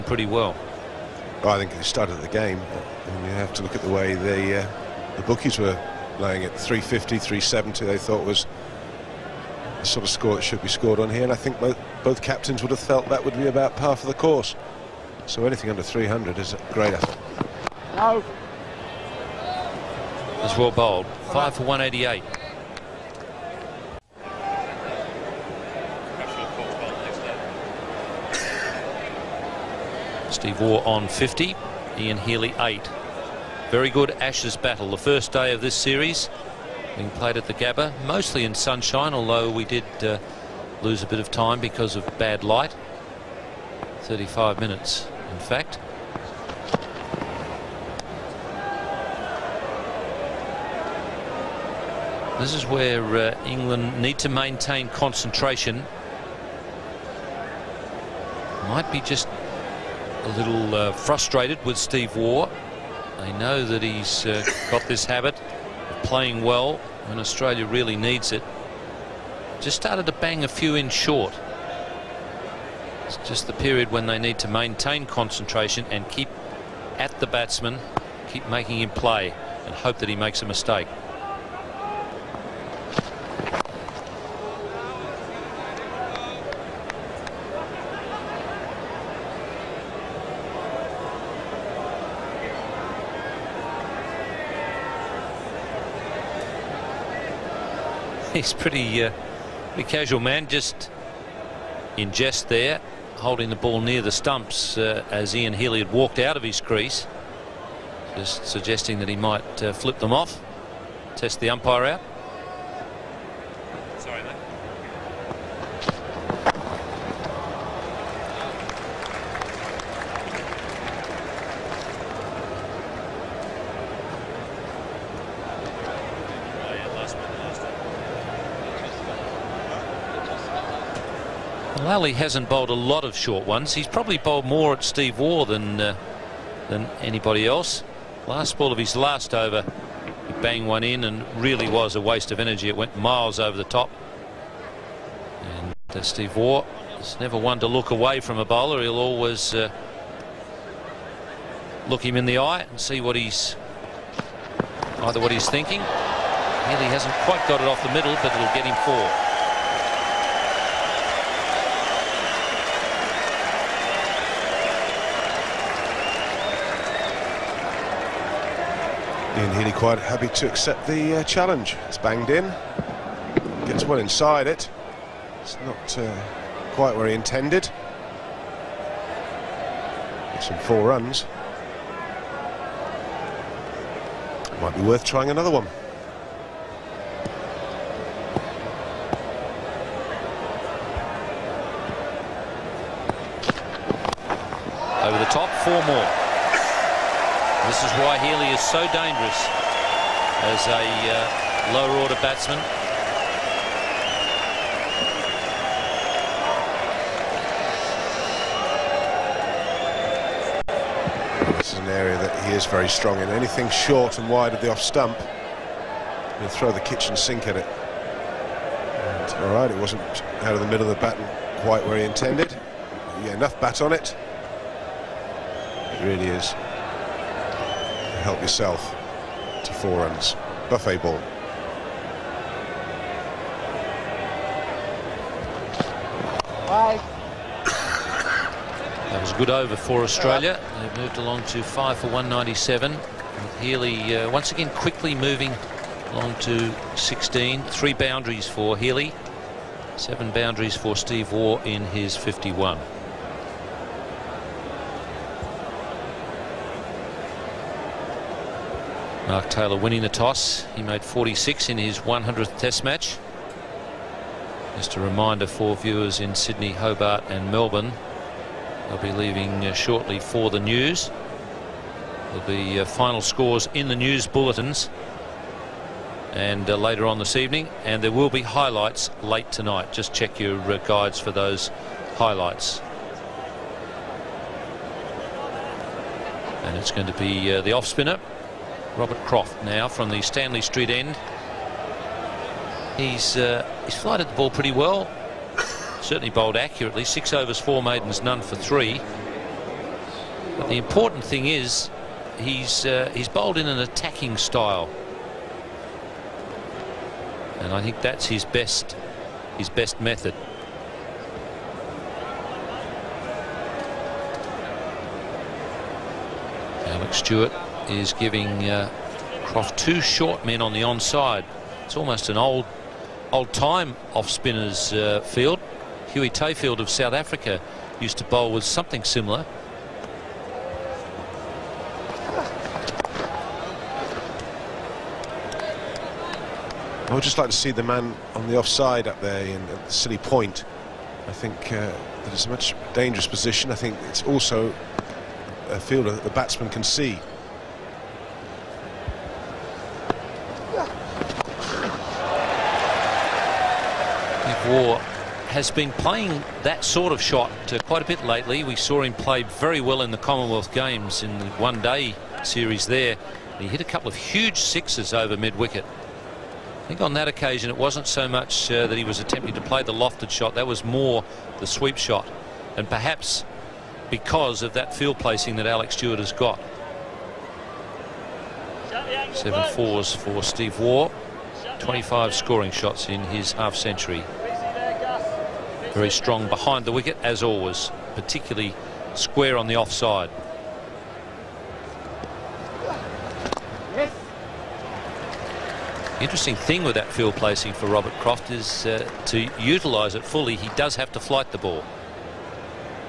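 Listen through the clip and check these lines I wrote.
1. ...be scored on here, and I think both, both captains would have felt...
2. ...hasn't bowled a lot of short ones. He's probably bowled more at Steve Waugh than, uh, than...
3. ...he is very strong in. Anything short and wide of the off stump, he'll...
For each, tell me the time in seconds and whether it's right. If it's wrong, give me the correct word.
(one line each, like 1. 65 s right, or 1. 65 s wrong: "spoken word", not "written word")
1. 10 s right
2. 132 s right
3. 212 s right.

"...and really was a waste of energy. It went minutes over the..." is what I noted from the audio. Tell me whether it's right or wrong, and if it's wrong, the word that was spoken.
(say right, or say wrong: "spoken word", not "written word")
wrong: "miles", not "minutes".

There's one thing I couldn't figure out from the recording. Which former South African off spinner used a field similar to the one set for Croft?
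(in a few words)
Huey Tayfield.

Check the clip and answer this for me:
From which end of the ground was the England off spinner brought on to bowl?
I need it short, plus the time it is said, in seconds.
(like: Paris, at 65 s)
Stanley Street end, at 290 s.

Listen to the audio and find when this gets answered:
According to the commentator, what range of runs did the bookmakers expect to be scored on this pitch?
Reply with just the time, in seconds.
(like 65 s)
6 s.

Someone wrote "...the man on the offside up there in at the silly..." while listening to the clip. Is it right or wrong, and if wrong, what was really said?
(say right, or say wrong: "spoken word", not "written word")
right.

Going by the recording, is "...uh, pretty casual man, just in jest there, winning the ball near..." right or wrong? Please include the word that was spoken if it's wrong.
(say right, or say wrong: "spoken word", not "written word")
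wrong: "holding", not "winning".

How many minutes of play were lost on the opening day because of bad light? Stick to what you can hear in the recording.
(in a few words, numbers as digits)
35.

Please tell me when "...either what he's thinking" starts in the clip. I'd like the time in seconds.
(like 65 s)
155 s.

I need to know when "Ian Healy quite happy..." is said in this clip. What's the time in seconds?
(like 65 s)
169 s.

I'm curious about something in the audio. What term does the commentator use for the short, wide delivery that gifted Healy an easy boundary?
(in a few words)
Buffet ball.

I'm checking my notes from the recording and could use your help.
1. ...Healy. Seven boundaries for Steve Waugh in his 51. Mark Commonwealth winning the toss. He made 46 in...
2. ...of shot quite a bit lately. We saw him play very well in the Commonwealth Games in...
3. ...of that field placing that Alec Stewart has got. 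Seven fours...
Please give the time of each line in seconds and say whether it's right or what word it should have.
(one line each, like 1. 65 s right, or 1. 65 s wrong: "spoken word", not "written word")
1. 248 s wrong: "Taylor", not "Commonwealth"
2. 357 s right
3. 374 s right.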